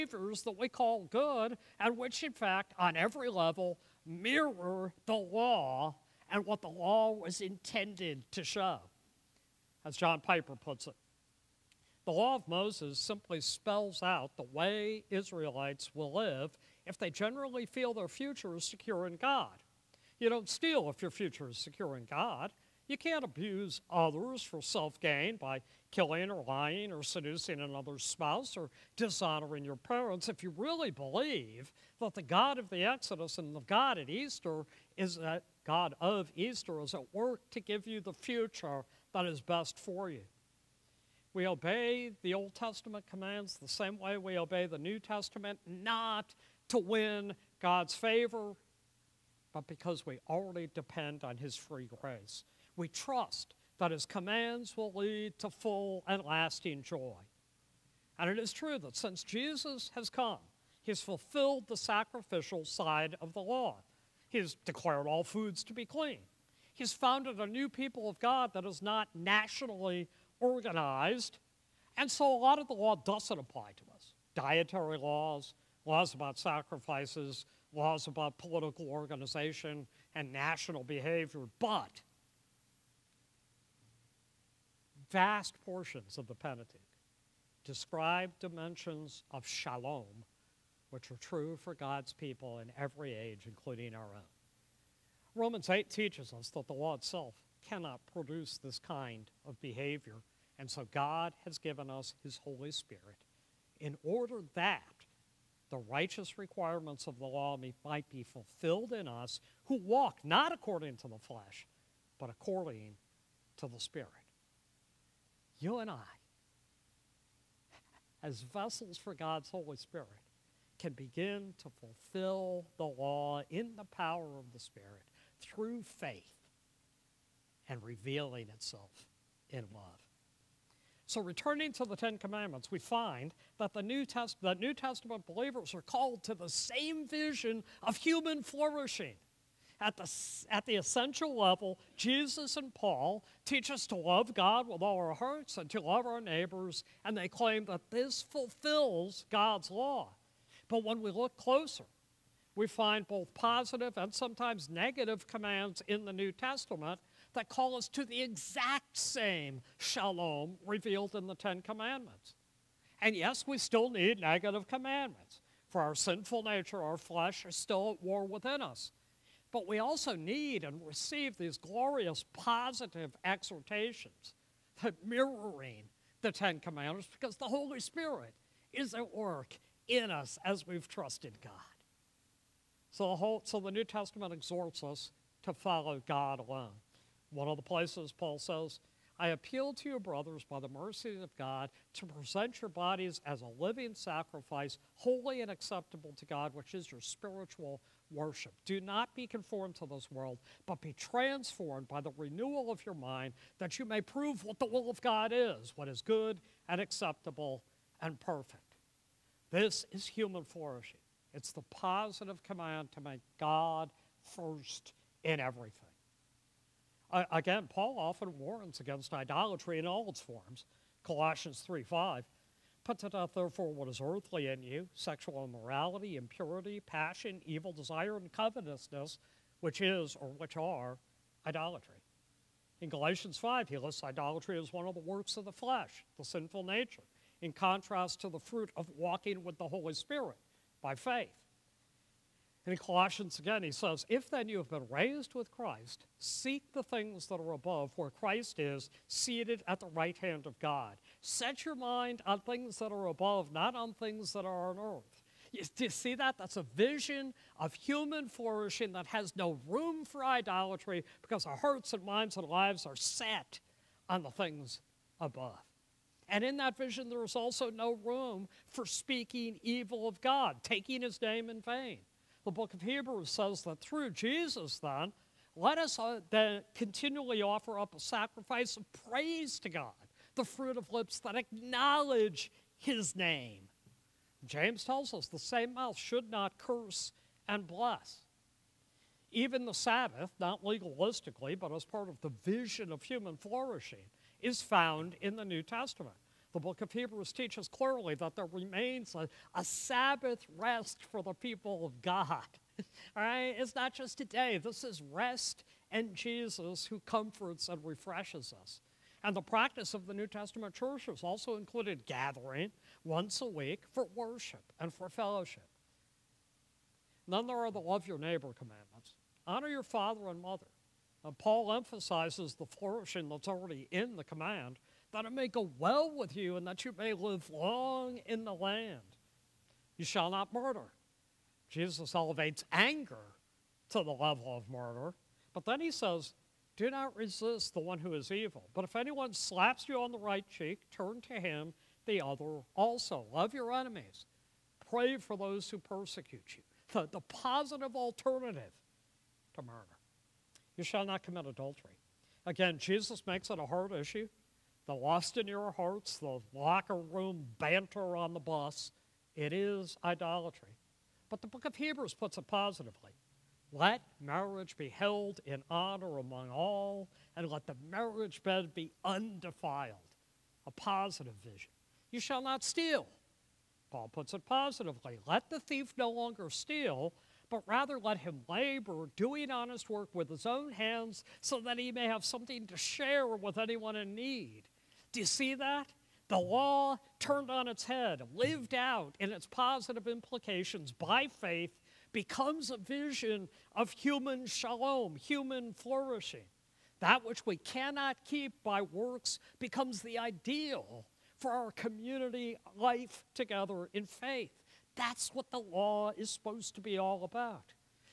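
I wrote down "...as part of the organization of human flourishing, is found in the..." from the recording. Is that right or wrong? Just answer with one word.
wrong.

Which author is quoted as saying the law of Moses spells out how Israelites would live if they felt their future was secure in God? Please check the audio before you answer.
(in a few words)
John Piper.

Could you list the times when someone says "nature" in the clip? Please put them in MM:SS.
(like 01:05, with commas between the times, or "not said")
02:46, 03:56.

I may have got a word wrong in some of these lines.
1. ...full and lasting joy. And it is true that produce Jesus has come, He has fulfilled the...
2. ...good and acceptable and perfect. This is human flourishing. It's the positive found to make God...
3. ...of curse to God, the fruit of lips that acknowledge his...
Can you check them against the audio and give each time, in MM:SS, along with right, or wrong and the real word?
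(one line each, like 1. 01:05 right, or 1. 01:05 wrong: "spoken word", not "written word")
1. 00:55 wrong: "since", not "produce"
2. 03:26 wrong: "command", not "found"
3. 04:38 wrong: "praise", not "curse".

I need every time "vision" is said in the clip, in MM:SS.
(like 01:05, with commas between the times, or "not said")
02:17, 04:16, 04:26, 04:52, 06:11, 06:32.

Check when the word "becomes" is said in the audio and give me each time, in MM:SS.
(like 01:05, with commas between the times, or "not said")
06:32, 06:39.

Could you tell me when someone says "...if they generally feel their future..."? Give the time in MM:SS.
00:16.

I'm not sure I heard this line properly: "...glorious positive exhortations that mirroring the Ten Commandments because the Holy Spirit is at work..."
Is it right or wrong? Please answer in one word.
right.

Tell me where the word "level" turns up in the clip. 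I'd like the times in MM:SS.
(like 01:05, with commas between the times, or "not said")
00:03, 02:21, 05:34.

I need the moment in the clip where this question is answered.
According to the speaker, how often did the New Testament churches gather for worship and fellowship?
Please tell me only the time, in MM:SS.
05:13.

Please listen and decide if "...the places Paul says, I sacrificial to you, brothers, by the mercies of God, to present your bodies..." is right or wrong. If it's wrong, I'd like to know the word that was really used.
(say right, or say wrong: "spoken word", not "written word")
wrong: "appeal", not "sacrificial".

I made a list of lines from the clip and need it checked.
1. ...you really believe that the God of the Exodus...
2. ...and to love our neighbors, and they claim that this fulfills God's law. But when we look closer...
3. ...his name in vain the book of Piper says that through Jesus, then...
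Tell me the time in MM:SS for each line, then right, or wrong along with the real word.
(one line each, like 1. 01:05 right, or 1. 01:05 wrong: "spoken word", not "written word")
1. 00:30 right
2. 02:25 right
3. 04:31 wrong: "Hebrews", not "Piper".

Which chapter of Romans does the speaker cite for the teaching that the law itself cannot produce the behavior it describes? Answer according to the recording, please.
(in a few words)
Romans 8.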